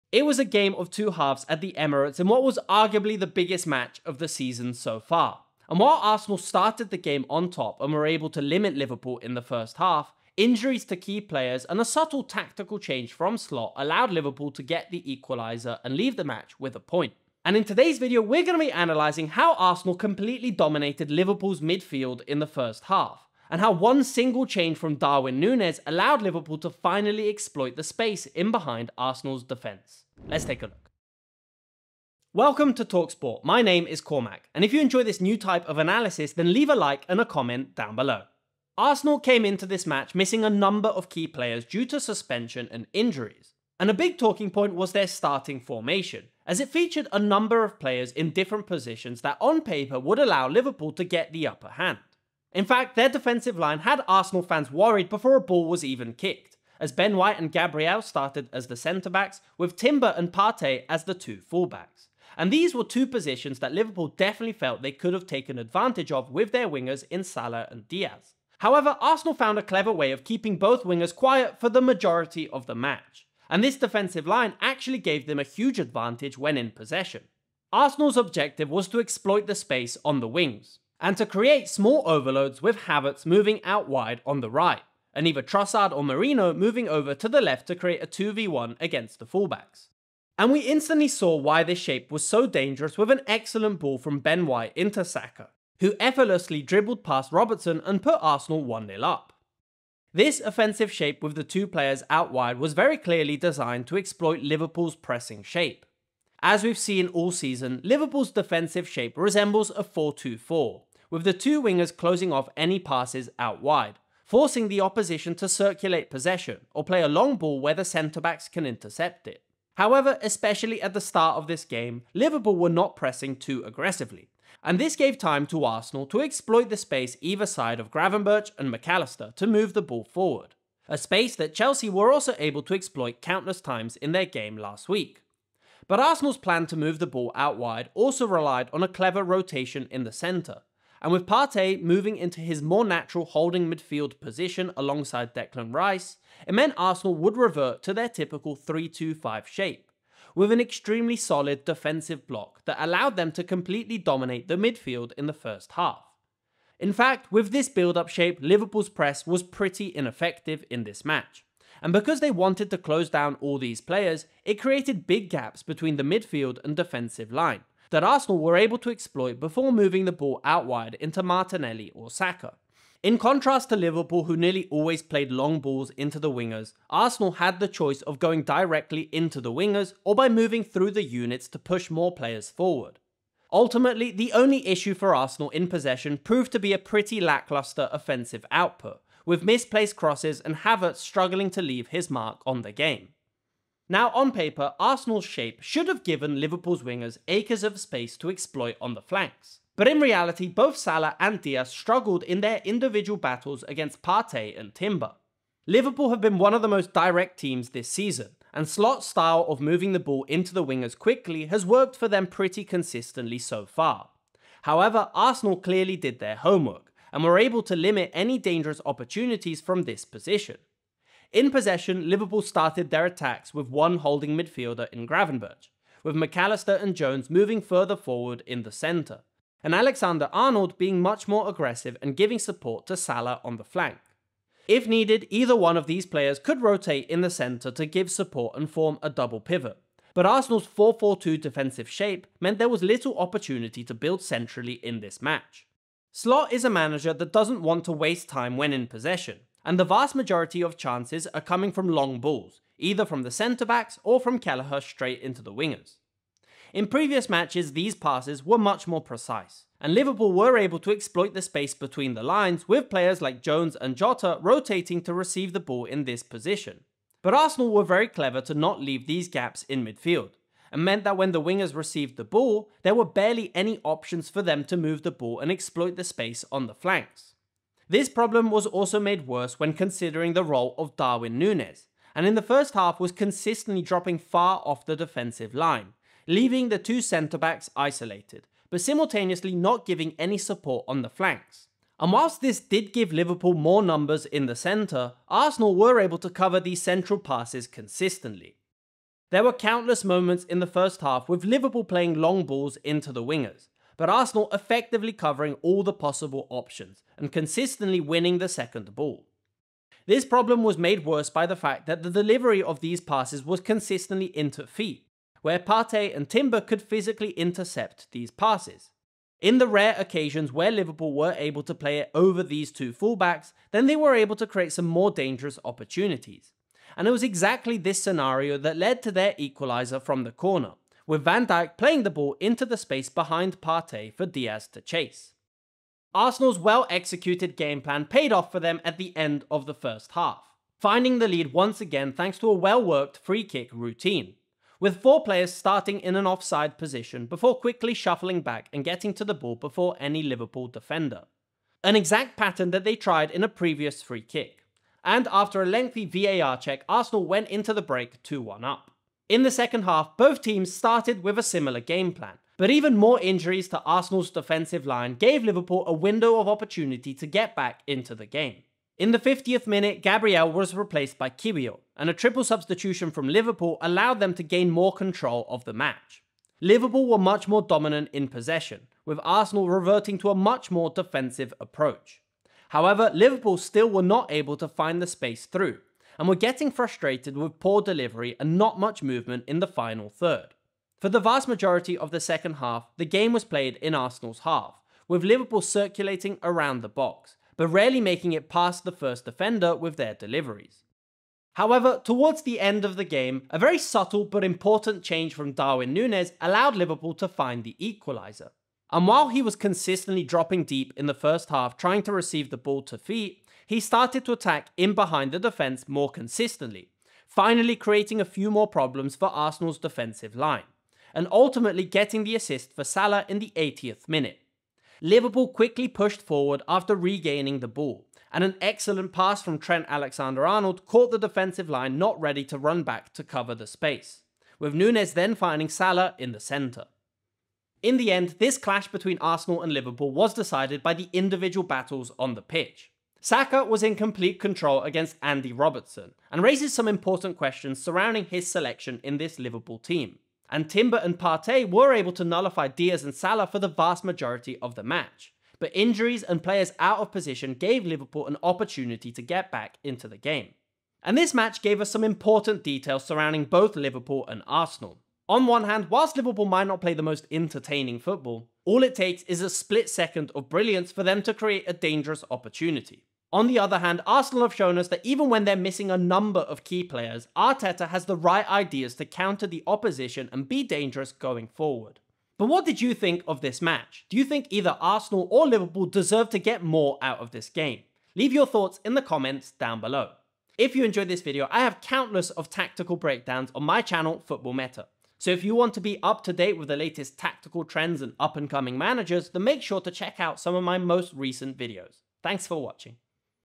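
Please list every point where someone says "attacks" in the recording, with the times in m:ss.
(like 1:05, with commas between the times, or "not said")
3:43, 6:54.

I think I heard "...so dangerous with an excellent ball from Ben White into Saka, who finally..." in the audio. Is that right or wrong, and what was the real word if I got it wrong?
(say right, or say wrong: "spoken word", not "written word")
wrong: "effortlessly", not "finally".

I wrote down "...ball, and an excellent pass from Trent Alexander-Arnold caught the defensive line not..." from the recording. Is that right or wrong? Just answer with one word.
right.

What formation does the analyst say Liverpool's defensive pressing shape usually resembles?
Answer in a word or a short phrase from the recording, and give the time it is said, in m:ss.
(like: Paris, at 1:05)
4-2-4, at 1:49.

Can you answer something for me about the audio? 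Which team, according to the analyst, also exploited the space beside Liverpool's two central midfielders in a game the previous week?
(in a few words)
Chelsea.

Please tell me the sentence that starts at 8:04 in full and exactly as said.
Do you think either Arsenal or Liverpool deserve to get more out of this game?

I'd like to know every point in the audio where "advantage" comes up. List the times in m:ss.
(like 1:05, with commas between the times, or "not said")
1:05, 1:15.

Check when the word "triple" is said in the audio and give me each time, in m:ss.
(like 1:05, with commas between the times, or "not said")
6:12.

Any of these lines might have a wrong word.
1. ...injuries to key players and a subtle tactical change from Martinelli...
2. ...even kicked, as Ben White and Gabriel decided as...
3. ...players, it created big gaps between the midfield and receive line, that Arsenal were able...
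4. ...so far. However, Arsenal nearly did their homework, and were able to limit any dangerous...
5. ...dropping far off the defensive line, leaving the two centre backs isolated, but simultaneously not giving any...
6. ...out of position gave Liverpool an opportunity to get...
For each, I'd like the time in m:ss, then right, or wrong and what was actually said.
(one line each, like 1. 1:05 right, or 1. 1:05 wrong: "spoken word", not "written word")
1. 0:10 wrong: "Slot", not "Martinelli"
2. 0:55 wrong: "started", not "decided"
3. 2:43 wrong: "defensive", not "receive"
4. 3:33 wrong: "clearly", not "nearly"
5. 4:43 right
6. 7:36 right.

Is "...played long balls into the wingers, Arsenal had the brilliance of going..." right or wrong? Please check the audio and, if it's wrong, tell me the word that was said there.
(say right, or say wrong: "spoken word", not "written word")
wrong: "choice", not "brilliance".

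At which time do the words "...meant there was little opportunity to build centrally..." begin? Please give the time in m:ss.
4:02.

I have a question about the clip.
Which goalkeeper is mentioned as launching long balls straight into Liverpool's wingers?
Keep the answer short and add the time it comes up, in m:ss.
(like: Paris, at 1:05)
Kelleher, at 4:14.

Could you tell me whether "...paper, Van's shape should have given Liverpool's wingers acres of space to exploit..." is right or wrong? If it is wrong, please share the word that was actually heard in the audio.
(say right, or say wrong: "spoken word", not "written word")
wrong: "Arsenal", not "Van".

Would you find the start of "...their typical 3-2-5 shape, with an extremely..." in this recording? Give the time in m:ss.
2:27.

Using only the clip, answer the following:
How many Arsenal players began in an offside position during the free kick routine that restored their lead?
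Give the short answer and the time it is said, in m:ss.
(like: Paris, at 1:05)
4, at 5:45.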